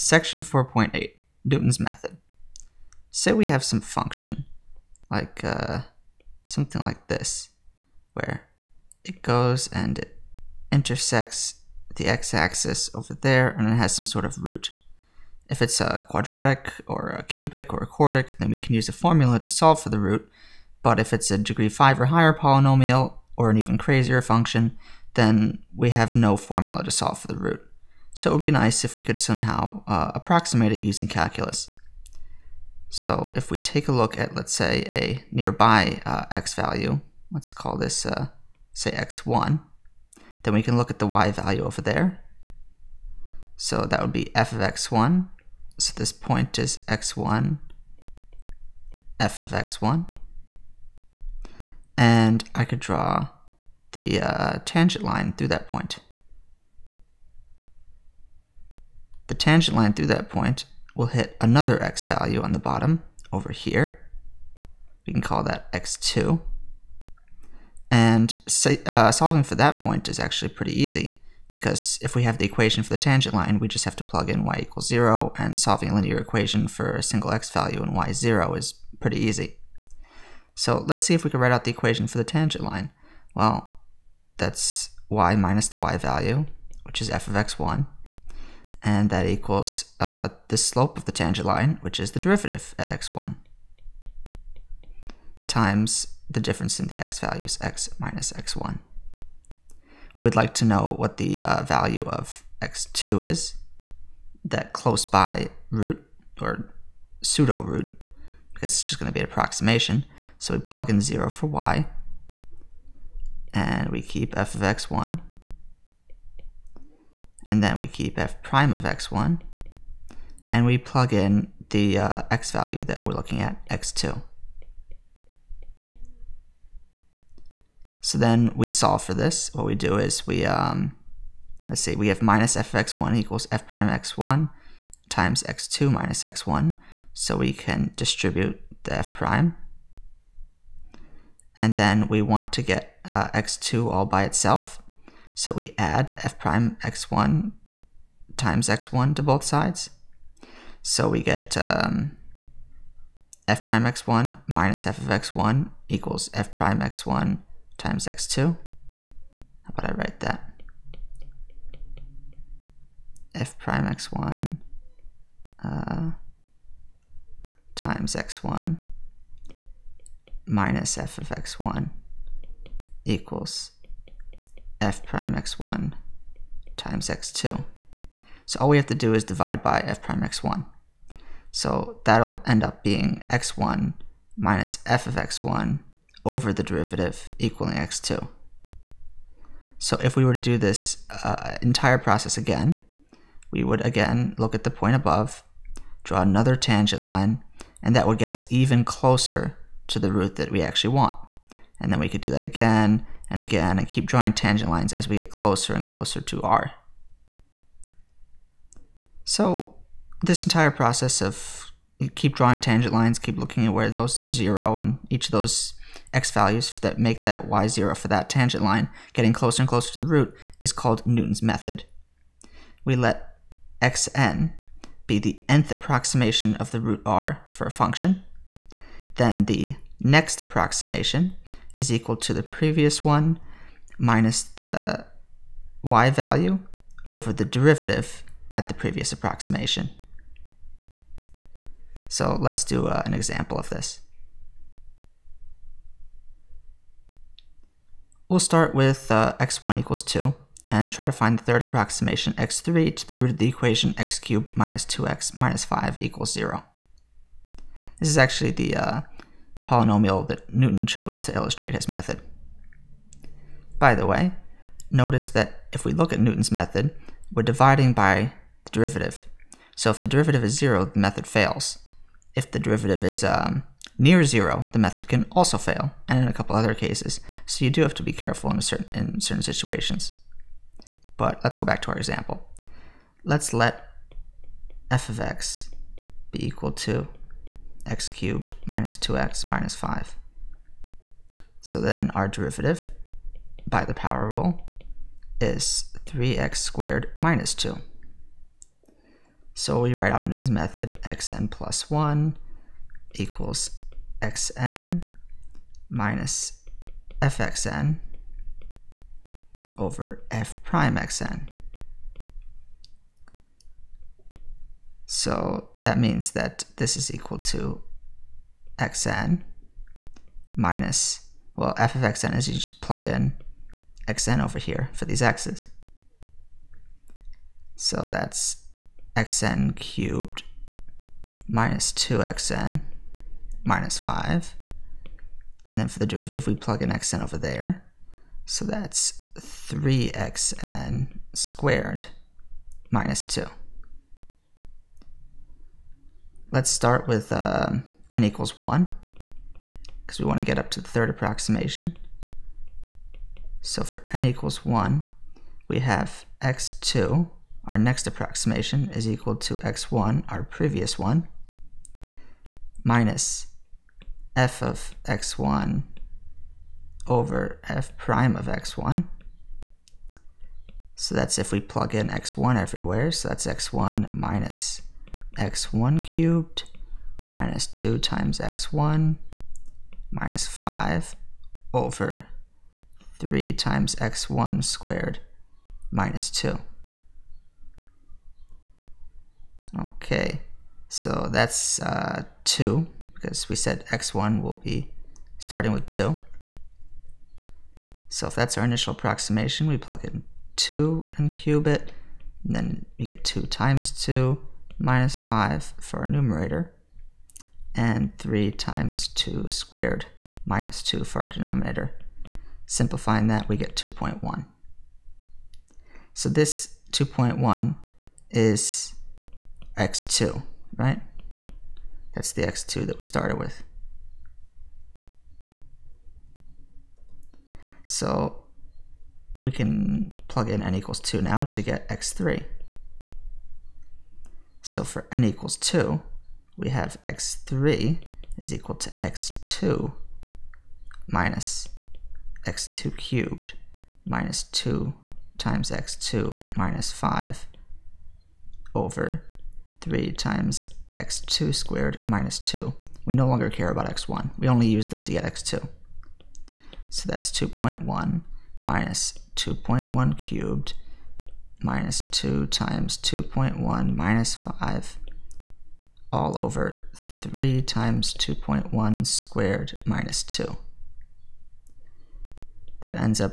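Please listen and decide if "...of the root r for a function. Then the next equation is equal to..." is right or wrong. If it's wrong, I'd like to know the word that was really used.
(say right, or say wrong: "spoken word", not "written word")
wrong: "approximation", not "equation".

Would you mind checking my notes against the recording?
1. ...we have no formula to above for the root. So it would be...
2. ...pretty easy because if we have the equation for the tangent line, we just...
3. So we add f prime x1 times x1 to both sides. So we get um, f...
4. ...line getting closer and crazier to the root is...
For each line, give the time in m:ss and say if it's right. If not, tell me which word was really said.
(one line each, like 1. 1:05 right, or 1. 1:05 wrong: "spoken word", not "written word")
1. 0:25 wrong: "solve", not "above"
2. 1:10 right
3. 2:25 right
4. 3:38 wrong: "closer", not "crazier".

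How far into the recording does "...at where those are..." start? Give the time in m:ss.
3:33.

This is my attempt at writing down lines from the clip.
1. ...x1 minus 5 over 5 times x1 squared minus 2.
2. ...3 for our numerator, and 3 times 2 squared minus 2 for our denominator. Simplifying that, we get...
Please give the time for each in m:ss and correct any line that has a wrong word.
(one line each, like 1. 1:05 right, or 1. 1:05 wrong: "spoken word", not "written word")
1. 6:18 wrong: "3", not "5"
2. 6:45 wrong: "5", not "3".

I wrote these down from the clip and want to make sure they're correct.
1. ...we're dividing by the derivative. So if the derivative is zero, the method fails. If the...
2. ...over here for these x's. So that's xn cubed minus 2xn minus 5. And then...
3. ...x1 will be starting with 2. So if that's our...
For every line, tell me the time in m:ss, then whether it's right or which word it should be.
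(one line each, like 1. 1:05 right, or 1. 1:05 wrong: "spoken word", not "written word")
1. 4:27 right
2. 5:24 right
3. 6:33 right.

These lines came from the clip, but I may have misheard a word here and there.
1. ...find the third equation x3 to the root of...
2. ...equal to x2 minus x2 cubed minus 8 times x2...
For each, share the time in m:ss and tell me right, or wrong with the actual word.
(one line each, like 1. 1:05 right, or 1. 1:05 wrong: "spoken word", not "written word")
1. 4:11 wrong: "approximation", not "equation"
2. 7:18 wrong: "2", not "8".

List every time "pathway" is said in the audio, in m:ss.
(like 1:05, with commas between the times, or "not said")
not said.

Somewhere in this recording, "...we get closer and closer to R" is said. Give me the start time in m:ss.
3:25.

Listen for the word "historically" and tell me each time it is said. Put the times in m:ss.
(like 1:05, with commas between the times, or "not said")
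not said.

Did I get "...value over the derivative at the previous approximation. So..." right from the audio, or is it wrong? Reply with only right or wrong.
right.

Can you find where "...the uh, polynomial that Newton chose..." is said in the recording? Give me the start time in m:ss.
4:18.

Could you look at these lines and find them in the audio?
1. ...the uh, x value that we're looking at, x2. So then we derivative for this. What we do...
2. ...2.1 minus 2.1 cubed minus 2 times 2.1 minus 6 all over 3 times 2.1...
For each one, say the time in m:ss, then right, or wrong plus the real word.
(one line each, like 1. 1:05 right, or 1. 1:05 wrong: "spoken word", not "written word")
1. 2:01 wrong: "solve", not "derivative"
2. 7:37 wrong: "5", not "6".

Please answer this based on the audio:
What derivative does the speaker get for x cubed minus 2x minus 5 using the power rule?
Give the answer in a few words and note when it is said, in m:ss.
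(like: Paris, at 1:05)
3x squared minus 2, at 4:56.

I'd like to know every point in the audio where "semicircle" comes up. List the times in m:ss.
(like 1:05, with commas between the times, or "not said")
not said.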